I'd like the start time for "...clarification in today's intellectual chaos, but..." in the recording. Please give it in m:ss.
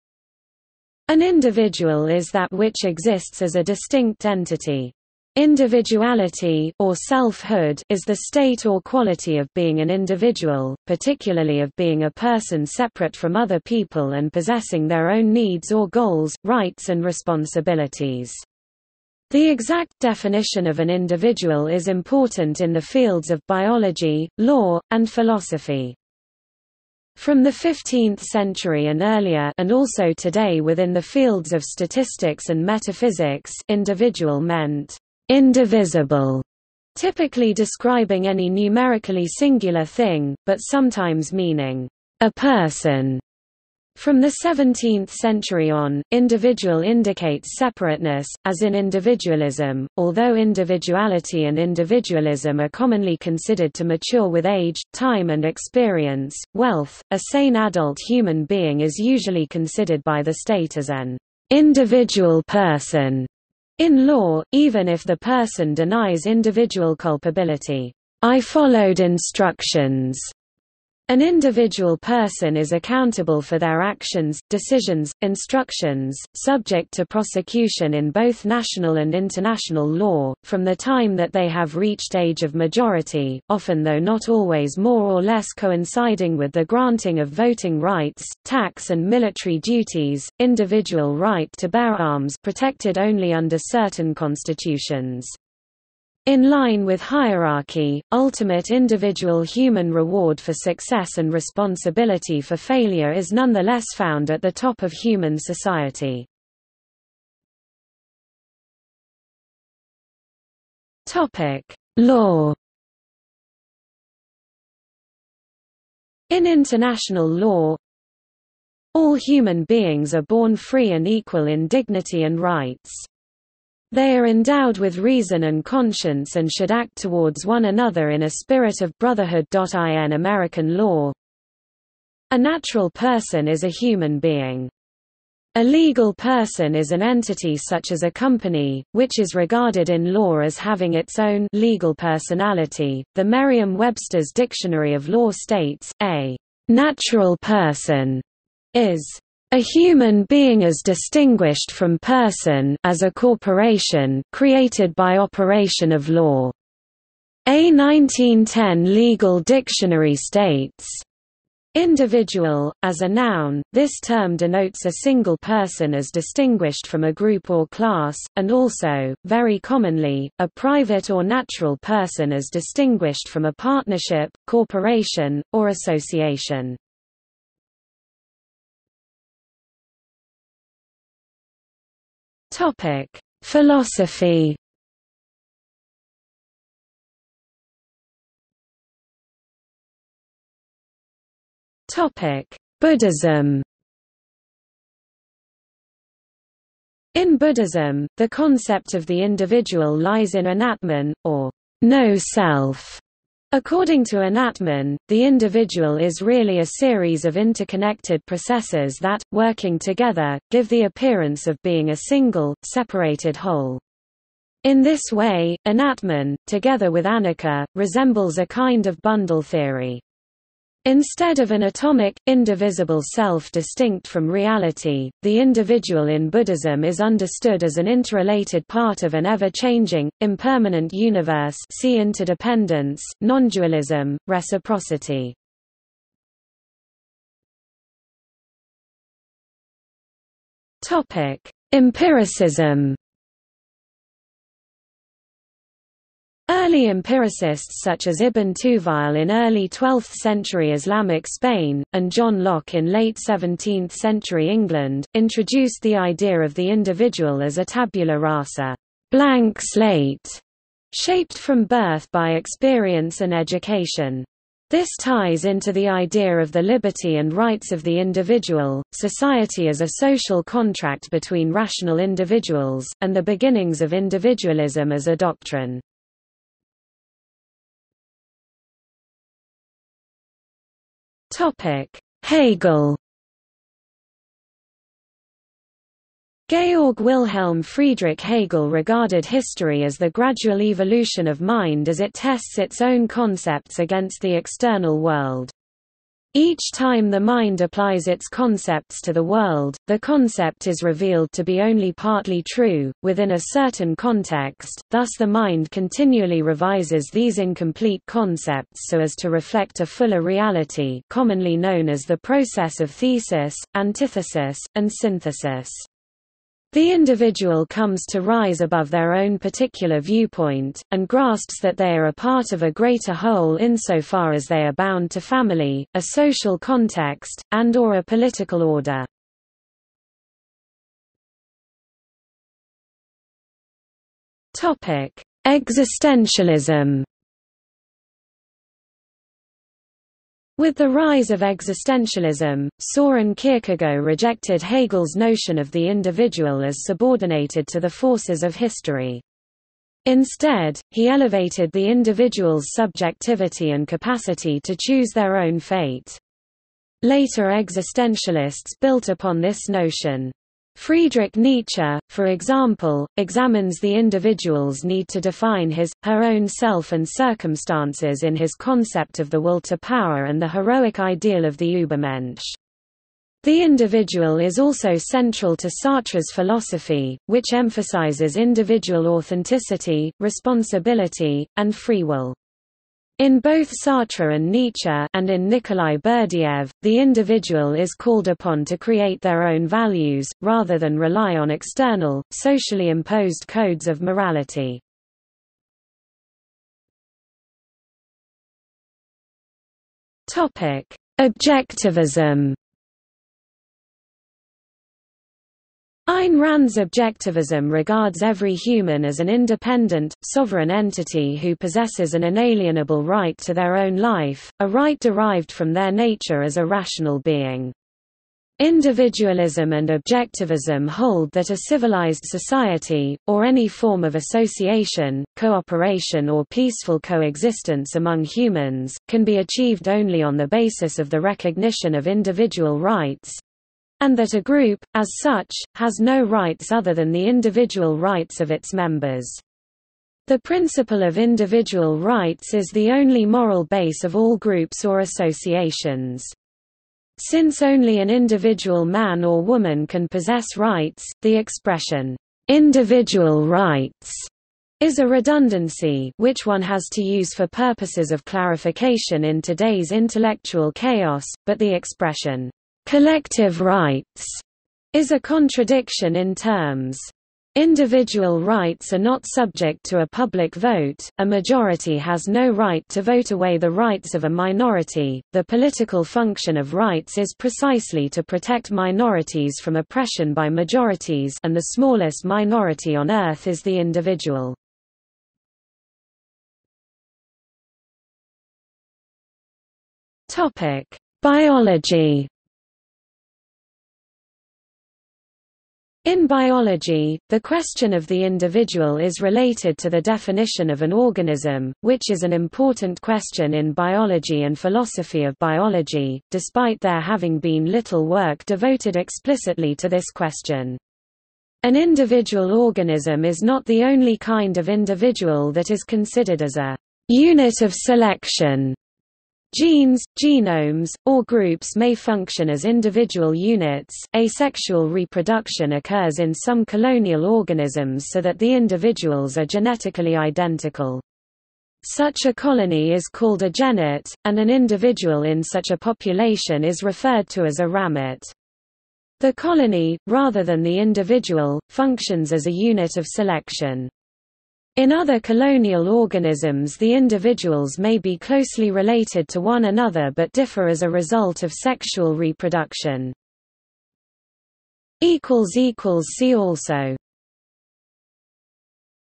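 7:38.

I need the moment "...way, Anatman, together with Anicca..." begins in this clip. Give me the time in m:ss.
3:35.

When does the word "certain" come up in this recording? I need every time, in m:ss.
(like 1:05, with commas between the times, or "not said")
1:33, 5:03.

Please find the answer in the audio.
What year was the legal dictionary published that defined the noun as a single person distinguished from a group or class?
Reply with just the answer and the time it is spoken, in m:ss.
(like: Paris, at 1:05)
1910, at 2:37.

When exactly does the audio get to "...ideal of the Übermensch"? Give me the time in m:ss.
6:10.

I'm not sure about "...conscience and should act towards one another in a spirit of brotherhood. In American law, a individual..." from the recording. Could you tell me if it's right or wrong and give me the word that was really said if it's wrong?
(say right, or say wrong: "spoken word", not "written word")
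wrong: "natural", not "individual".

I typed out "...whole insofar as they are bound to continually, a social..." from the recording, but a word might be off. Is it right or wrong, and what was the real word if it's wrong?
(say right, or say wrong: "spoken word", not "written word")
wrong: "family", not "continually".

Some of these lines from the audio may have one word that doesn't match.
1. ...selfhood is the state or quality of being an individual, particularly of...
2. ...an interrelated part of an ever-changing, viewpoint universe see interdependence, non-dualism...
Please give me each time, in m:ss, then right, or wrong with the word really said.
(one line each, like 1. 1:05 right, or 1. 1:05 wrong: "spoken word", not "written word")
1. 0:06 right
2. 3:47 wrong: "impermanent", not "viewpoint".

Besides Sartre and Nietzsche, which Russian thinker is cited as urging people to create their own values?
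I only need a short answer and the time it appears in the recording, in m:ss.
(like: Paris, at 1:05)
Nikolai Berdyaev, at 6:25.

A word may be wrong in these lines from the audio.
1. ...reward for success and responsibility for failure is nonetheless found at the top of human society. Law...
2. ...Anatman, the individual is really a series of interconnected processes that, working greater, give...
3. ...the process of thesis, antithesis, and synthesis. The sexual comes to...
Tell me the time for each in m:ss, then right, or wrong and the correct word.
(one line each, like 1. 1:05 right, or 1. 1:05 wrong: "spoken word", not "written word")
1. 1:39 right
2. 3:24 wrong: "together", not "greater"
3. 5:12 wrong: "individual", not "sexual".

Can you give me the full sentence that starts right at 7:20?
The principle of individual rights is the only moral base of all groups or associations.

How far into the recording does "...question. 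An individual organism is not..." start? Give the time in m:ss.
8:30.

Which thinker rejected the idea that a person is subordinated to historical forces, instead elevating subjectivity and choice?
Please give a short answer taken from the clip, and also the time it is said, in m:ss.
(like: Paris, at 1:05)
Soren Kierkegaard, at 5:42.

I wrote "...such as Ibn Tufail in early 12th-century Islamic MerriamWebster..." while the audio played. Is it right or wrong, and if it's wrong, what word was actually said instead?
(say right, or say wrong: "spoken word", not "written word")
wrong: "Spain", not "MerriamWebster".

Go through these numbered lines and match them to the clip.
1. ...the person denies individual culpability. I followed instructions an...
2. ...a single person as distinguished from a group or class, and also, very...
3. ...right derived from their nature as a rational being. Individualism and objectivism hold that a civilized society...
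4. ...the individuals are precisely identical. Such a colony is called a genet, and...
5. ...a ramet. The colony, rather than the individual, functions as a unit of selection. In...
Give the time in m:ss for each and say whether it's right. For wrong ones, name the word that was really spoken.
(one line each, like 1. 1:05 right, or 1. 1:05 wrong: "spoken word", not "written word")
1. 1:05 right
2. 2:44 right
3. 6:54 right
4. 8:48 wrong: "genetically", not "precisely"
5. 8:57 right.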